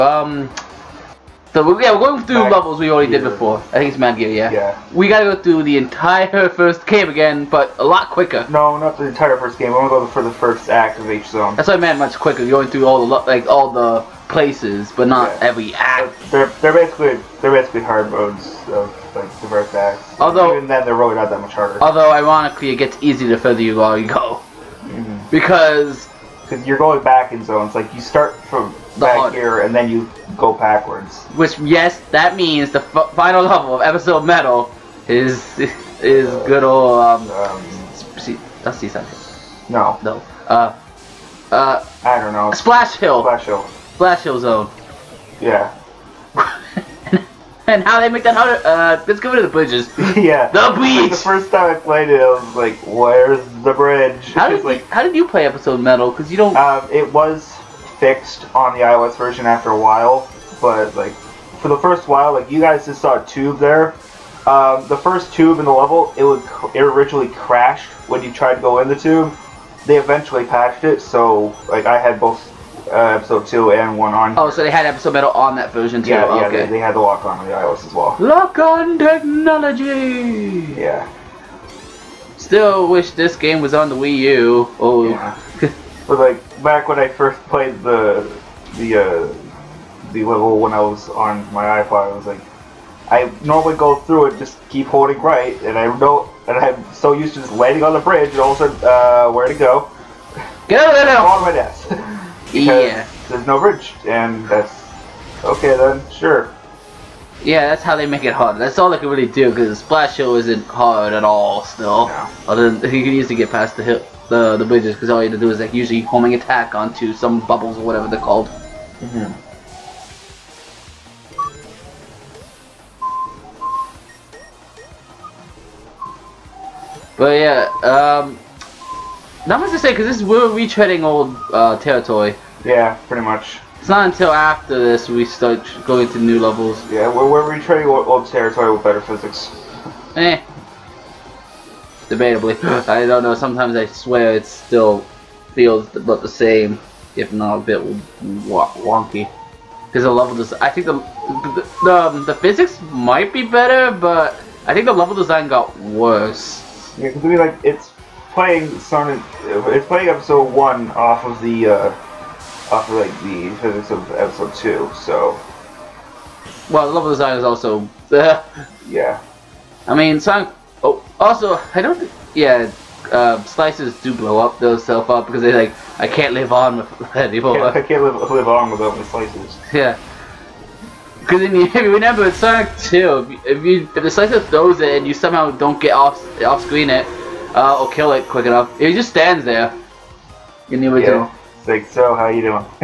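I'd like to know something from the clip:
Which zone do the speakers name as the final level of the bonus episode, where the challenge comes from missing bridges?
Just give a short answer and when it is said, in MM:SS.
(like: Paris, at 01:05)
Splash Hill Zone, at 00:43.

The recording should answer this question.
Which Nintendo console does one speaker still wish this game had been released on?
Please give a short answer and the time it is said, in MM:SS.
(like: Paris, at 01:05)
Wii U, at 01:23.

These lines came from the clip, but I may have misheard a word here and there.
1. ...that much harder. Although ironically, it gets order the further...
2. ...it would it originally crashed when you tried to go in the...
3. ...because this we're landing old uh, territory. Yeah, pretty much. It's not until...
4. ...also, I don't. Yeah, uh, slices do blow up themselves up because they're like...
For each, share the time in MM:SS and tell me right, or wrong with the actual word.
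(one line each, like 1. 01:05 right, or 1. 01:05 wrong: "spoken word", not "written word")
1. 00:21 wrong: "easier", not "order"
2. 01:06 right
3. 02:09 wrong: "retreading", not "landing"
4. 02:51 right.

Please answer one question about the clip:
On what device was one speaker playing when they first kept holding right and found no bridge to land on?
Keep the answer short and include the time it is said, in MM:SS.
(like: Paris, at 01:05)
iPod, at 01:31.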